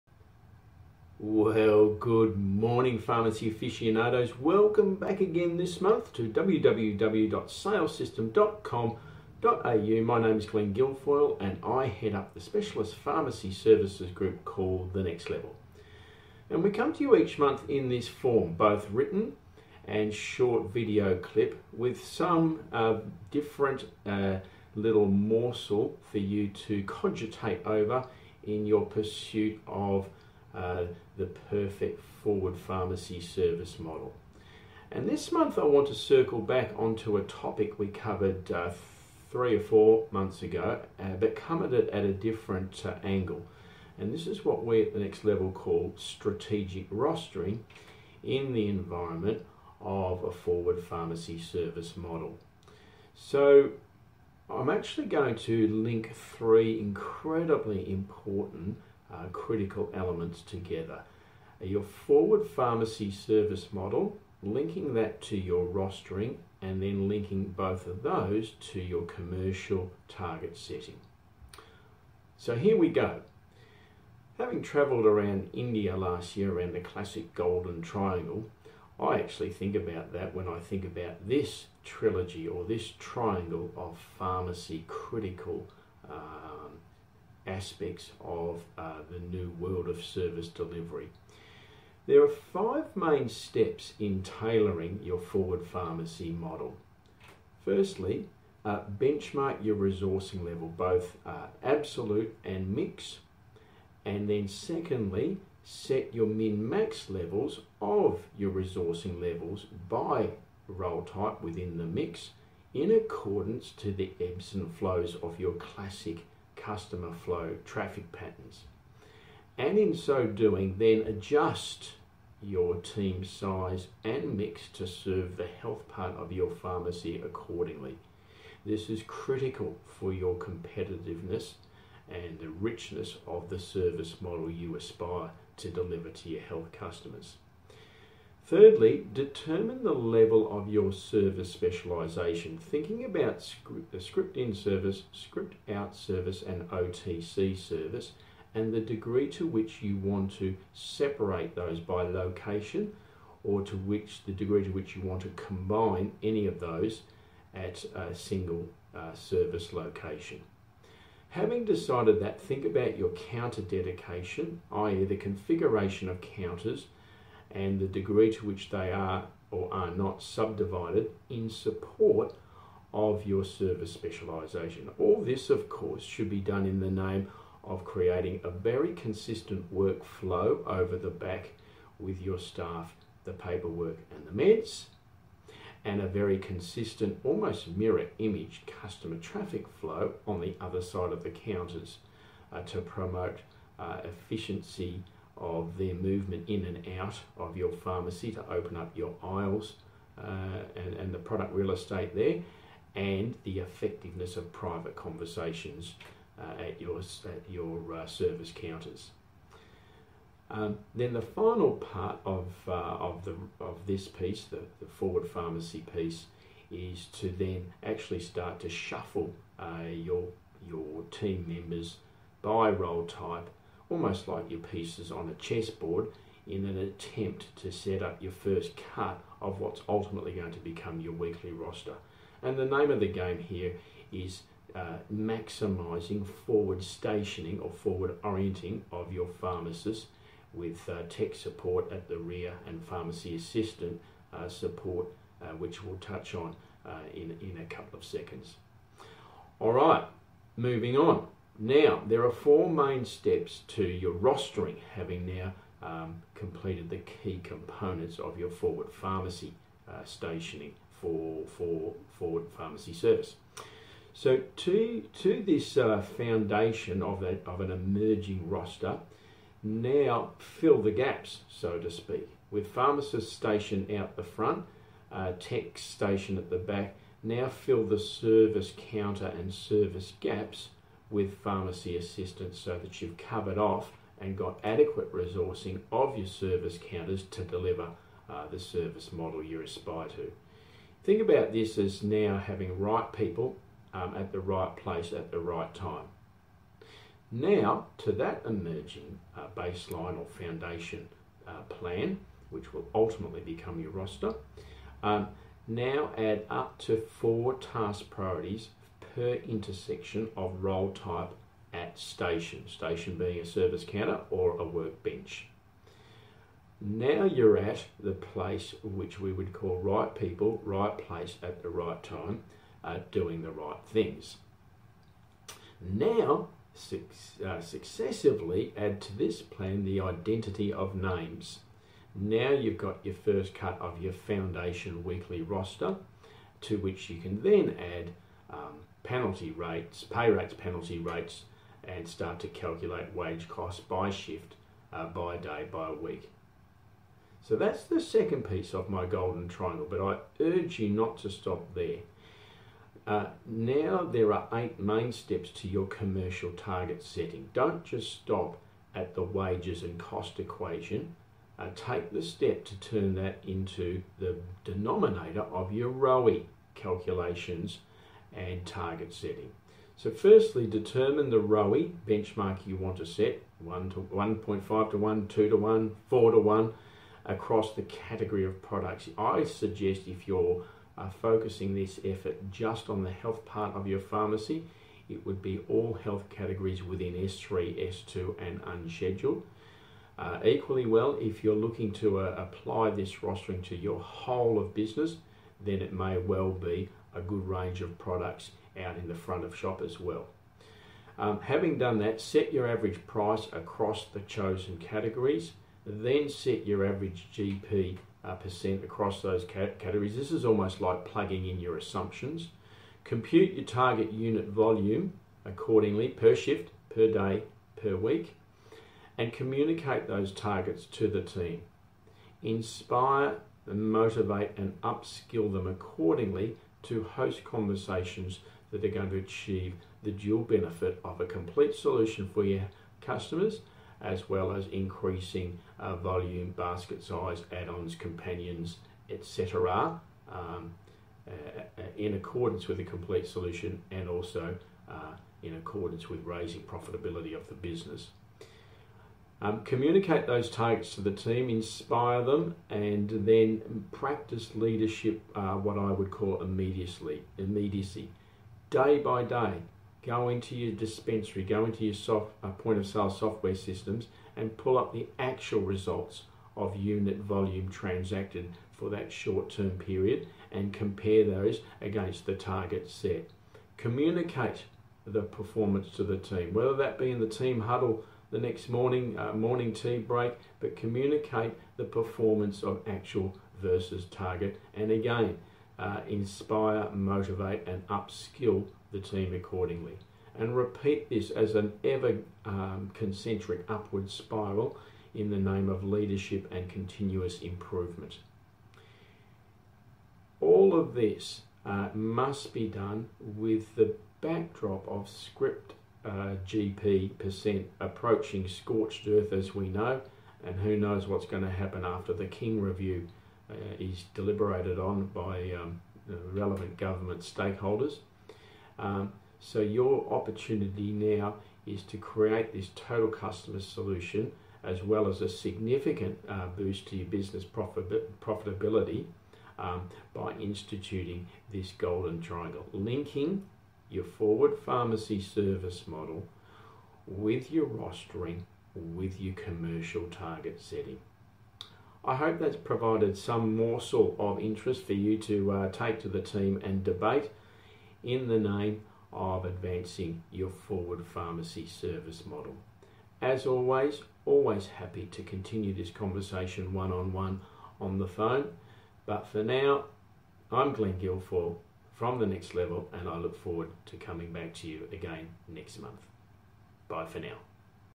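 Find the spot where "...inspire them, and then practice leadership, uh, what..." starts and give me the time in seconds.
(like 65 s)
451 s.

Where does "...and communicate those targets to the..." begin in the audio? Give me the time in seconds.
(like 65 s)
419 s.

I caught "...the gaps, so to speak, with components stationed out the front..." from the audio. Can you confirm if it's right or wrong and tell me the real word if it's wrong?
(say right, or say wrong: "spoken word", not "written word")
wrong: "pharmacists", not "components".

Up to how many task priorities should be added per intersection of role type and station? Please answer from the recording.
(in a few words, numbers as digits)
4.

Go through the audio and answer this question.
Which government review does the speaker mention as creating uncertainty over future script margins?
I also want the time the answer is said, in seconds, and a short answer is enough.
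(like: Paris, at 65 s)
King review, at 512 s.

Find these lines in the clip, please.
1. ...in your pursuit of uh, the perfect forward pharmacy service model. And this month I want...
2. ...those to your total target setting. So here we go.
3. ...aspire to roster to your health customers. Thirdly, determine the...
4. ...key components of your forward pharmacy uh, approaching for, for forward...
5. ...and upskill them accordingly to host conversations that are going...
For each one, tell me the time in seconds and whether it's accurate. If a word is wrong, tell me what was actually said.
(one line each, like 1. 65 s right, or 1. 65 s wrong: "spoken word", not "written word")
1. 28 s right
2. 68 s wrong: "commercial", not "total"
3. 134 s wrong: "deliver", not "roster"
4. 256 s wrong: "stationing", not "approaching"
5. 424 s right.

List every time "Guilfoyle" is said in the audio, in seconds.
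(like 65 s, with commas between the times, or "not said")
10 s, 560 s.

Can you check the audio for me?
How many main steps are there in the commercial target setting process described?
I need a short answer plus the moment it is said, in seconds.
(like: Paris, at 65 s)
8, at 354 s.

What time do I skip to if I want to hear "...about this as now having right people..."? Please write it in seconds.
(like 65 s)
291 s.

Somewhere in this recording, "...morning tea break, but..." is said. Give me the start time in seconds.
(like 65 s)
479 s.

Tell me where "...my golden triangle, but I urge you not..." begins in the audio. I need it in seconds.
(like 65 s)
348 s.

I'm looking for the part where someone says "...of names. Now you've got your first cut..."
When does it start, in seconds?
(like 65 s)
330 s.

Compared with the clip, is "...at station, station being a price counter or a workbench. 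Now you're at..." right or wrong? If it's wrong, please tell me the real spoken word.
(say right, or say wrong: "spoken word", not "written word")
wrong: "service", not "price".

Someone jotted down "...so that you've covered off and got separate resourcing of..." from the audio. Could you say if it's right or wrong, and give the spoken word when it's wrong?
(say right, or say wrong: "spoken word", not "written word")
wrong: "adequate", not "separate".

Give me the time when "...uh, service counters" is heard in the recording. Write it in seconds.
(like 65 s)
207 s.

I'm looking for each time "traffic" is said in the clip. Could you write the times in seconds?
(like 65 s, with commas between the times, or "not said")
117 s, 189 s.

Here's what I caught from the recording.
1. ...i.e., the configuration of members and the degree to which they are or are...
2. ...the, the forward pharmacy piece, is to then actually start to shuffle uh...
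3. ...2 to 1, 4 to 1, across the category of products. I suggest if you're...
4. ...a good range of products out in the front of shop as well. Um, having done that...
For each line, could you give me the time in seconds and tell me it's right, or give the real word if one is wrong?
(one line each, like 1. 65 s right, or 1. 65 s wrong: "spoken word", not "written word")
1. 164 s wrong: "counters", not "members"
2. 214 s right
3. 375 s right
4. 397 s right.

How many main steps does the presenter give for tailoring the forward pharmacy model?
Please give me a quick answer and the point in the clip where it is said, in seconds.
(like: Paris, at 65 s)
5, at 92 s.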